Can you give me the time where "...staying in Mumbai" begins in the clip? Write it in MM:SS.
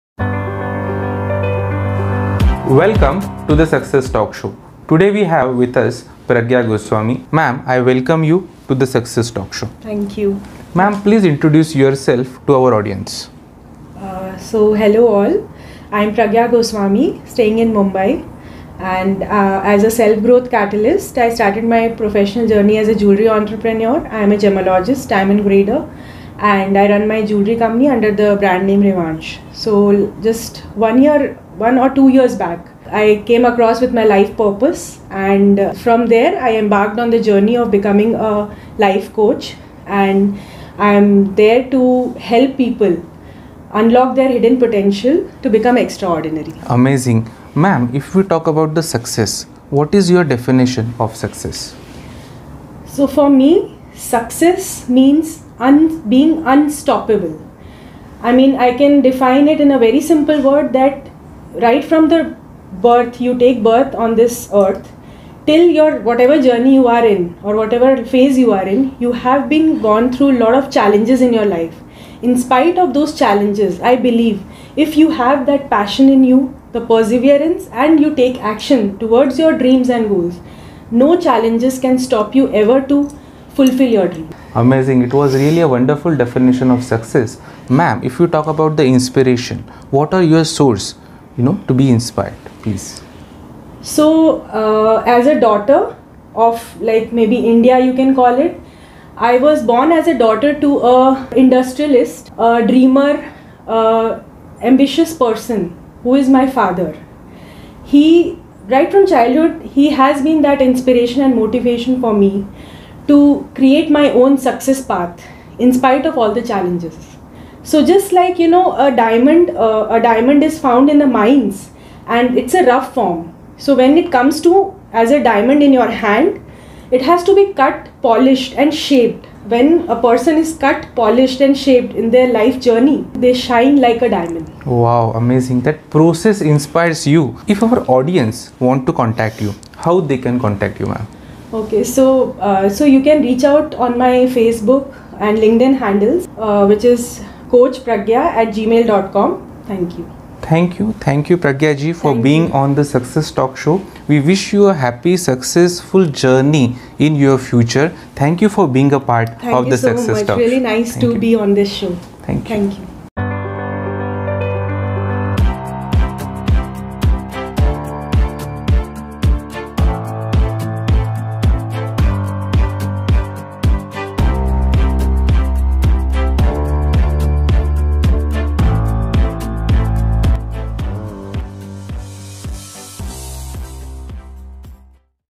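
00:17.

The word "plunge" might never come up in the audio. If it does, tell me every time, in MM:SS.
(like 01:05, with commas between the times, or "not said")
not said.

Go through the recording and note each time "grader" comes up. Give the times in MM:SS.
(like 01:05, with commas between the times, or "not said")
00:25.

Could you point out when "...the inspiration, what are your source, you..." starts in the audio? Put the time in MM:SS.
01:28.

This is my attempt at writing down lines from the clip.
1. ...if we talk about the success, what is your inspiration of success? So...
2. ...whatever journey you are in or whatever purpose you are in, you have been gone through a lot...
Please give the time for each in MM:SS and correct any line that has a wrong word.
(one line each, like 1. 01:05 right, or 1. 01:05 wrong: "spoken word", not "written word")
1. 00:47 wrong: "definition", not "inspiration"
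2. 01:06 wrong: "phase", not "purpose".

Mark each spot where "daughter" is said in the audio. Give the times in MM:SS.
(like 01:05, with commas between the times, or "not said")
01:35, 01:40.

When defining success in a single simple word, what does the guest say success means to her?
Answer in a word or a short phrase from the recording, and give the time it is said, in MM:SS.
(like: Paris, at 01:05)
Being unstoppable, at 00:56.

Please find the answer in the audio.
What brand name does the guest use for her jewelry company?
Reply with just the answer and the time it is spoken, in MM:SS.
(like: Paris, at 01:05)
Revanche, at 00:28.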